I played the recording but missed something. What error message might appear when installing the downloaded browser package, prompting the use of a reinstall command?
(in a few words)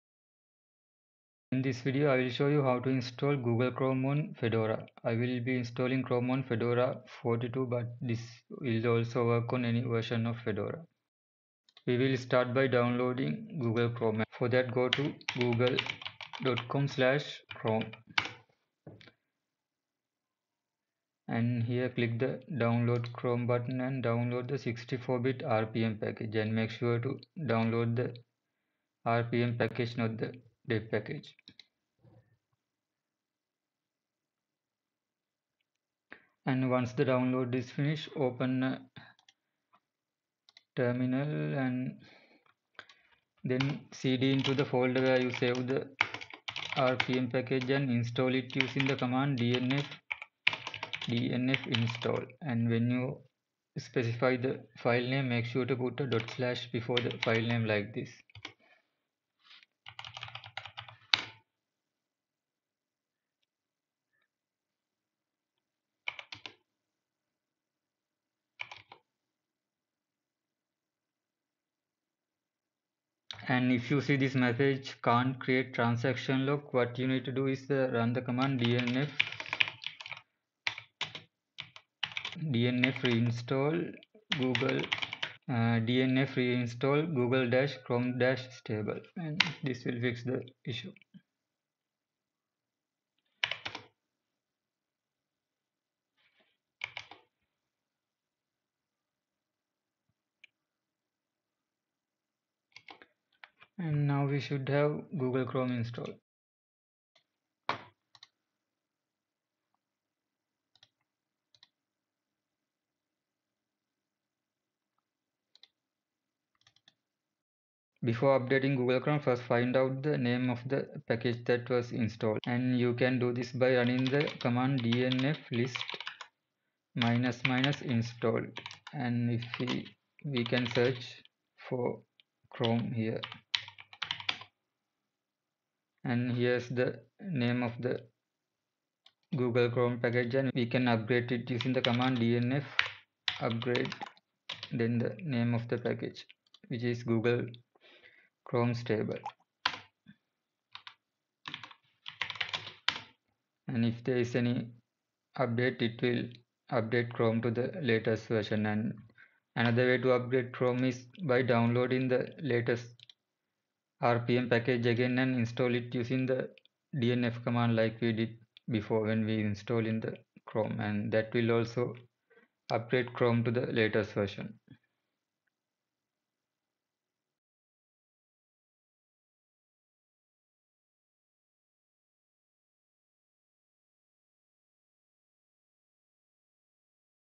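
can't create transaction lock.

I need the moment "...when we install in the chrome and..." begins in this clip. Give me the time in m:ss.
2:49.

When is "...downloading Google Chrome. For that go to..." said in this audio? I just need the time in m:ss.
0:12.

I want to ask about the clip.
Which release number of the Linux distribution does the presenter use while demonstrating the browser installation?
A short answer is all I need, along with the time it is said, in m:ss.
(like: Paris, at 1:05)
42, at 0:06.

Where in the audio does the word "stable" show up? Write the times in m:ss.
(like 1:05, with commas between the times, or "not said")
1:28, 2:28.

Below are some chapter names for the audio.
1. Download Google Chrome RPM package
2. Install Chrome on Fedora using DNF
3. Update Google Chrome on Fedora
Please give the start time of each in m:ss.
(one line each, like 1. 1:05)
1. 0:11
2. 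0:35
3. 1:57.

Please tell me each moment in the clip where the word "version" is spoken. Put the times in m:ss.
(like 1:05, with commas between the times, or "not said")
0:09, 2:38, 2:54.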